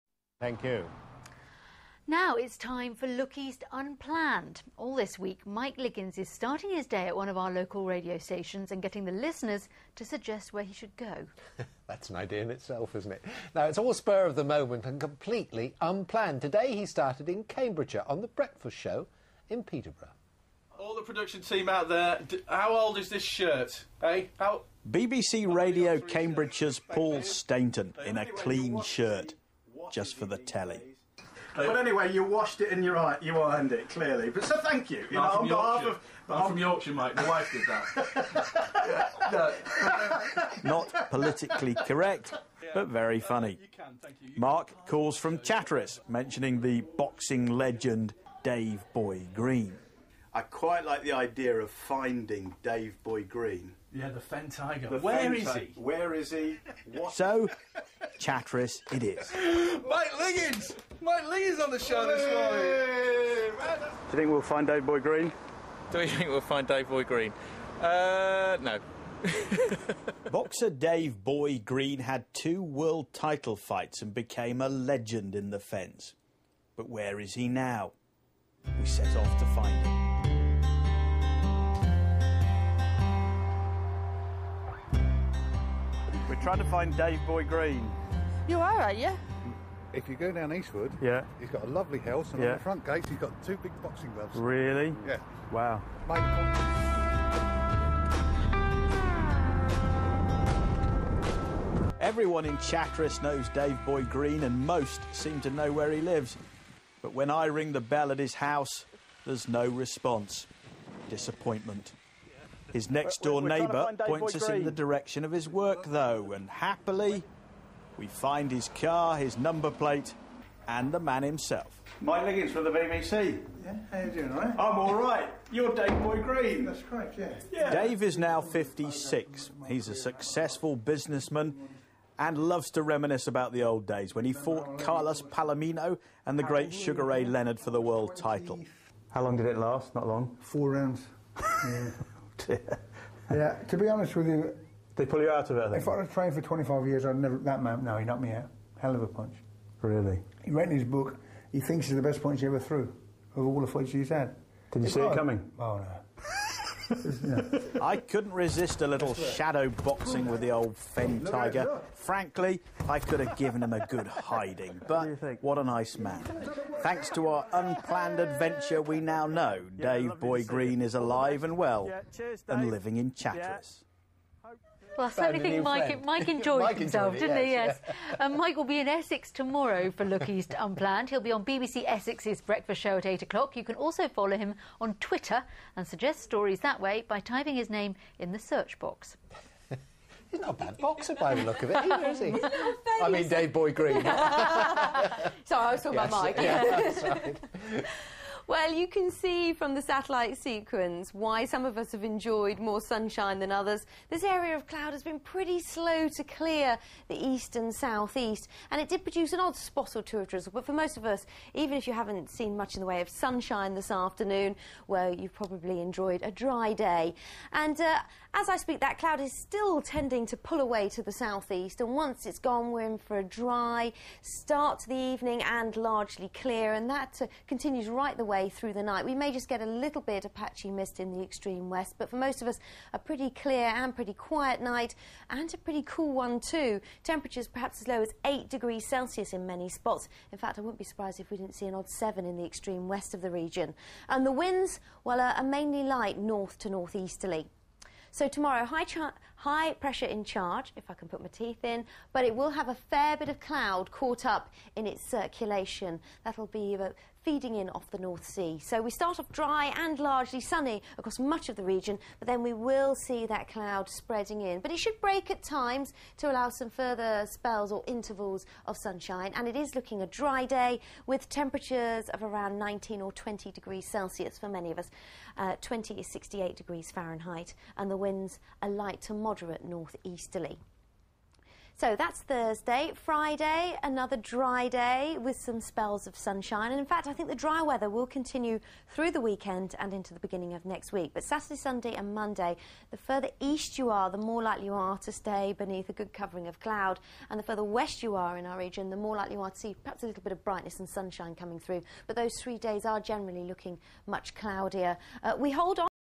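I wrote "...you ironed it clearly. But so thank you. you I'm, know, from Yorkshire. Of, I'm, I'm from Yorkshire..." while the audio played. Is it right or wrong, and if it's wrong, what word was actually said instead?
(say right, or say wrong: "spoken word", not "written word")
right.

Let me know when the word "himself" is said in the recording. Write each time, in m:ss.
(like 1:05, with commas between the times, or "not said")
2:01, 2:56.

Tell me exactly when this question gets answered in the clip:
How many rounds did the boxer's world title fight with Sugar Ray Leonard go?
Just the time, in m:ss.
2:20.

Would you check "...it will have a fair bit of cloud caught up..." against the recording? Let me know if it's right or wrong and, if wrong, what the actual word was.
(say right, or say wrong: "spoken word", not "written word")
right.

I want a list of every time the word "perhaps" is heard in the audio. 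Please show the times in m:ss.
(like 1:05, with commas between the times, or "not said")
3:57, 4:59.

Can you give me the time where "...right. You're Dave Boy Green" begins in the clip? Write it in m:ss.
2:04.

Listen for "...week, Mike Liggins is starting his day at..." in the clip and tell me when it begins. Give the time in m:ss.
0:05.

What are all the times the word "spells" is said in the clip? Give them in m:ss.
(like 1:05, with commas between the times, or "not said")
4:27, 4:45.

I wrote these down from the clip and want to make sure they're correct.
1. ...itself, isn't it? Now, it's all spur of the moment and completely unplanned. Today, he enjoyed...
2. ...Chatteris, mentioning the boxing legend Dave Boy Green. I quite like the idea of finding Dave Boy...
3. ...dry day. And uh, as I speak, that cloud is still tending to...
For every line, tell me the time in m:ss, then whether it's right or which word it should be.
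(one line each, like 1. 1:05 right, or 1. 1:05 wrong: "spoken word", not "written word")
1. 0:12 wrong: "started", not "enjoyed"
2. 0:45 right
3. 3:36 right.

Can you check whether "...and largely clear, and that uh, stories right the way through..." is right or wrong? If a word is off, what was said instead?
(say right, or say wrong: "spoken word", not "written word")
wrong: "continues", not "stories".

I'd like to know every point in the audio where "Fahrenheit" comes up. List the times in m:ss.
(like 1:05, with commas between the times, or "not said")
4:36.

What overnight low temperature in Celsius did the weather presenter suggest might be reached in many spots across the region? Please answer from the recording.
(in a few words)
8.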